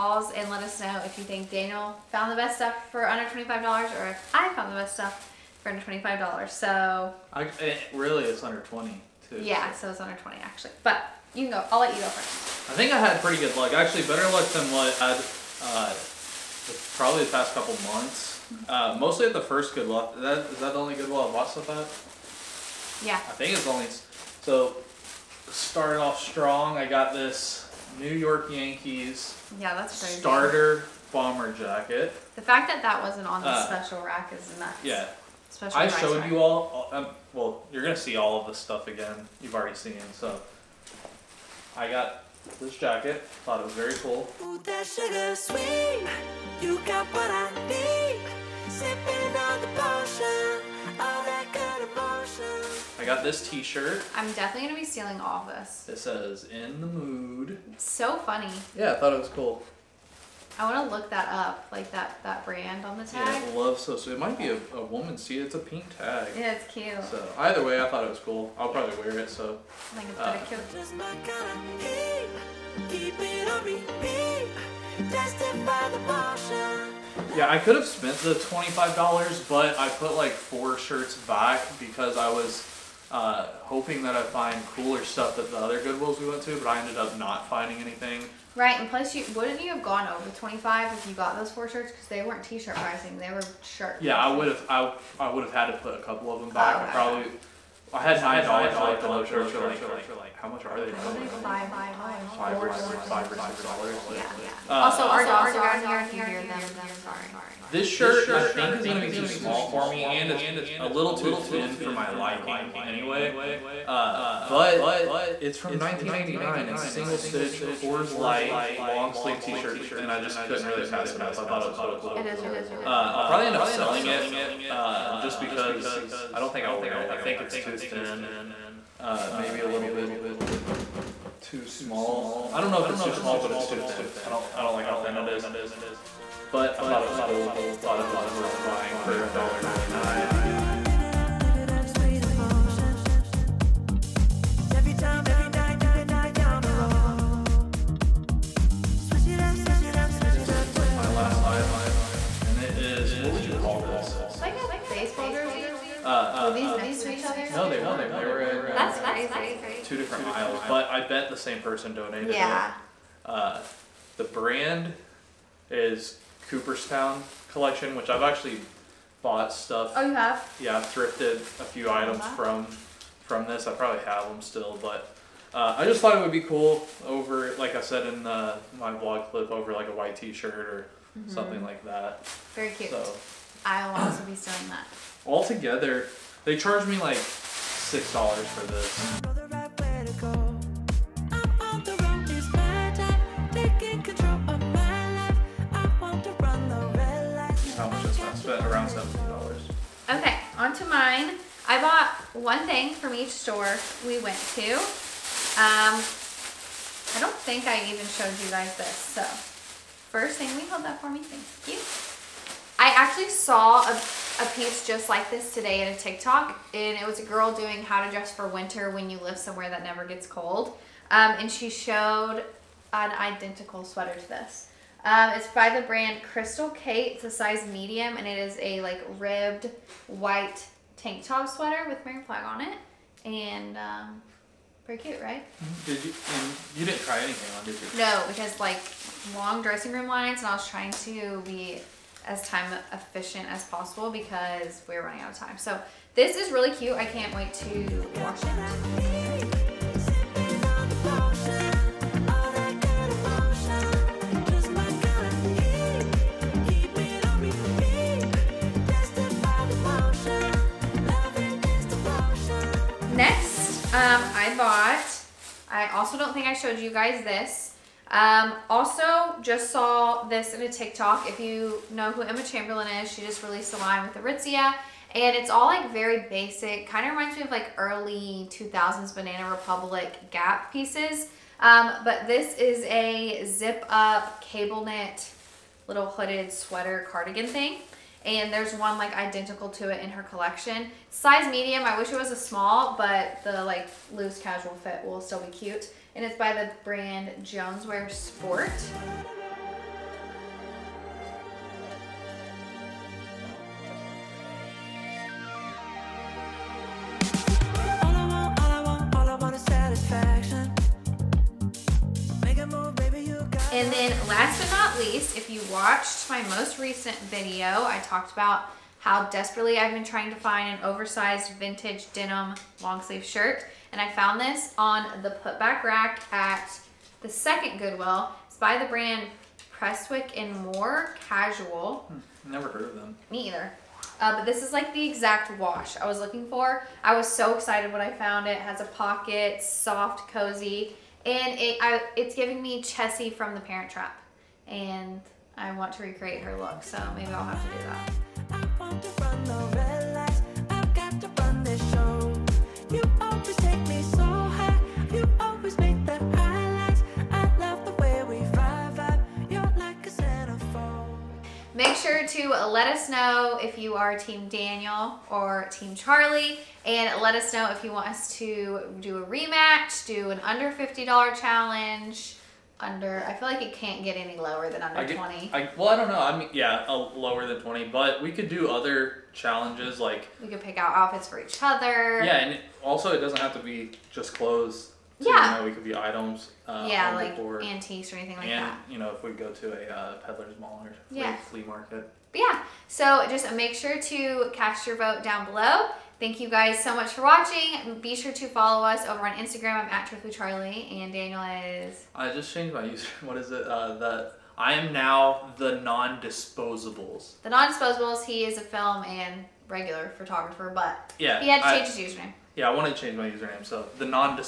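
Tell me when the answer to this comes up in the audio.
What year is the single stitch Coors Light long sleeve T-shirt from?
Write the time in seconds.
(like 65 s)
115 s.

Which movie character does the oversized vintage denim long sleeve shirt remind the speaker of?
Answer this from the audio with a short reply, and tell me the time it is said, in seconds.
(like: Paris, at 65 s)
Chessy, at 342 s.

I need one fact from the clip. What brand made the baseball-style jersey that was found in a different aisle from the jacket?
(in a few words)
Cooperstown Collection.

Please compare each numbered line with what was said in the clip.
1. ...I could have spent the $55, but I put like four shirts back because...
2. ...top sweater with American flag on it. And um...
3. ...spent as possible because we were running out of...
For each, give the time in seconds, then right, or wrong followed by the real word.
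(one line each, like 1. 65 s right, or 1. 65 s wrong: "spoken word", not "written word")
1. 77 s wrong: "25", not "55"
2. 231 s right
3. 242 s wrong: "efficient", not "spent".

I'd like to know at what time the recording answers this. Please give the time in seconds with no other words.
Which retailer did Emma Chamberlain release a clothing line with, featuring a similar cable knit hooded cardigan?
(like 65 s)
274 s.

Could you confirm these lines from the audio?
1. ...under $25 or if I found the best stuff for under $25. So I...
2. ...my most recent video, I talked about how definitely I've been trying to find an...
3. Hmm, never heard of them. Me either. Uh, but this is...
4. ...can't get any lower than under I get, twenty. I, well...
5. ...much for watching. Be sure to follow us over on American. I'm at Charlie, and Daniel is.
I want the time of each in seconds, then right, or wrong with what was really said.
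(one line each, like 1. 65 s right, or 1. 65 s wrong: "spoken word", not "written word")
1. 3 s right
2. 316 s wrong: "desperately", not "definitely"
3. 332 s right
4. 373 s right
5. 396 s wrong: "Instagram", not "American".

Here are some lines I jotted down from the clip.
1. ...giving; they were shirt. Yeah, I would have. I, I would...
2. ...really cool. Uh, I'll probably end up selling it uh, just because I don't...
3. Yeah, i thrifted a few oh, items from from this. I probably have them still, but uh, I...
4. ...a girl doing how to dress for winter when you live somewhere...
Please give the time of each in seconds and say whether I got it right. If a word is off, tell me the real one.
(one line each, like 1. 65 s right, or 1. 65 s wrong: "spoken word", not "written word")
1. 92 s wrong: "pricing", not "giving"
2. 122 s right
3. 170 s right
4. 217 s right.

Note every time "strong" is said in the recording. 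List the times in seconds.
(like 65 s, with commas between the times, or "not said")
26 s.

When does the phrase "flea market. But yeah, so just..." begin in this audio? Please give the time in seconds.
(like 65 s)
391 s.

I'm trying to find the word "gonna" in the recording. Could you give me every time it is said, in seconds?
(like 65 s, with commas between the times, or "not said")
37 s, 108 s.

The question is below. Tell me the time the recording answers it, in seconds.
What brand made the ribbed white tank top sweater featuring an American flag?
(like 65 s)
226 s.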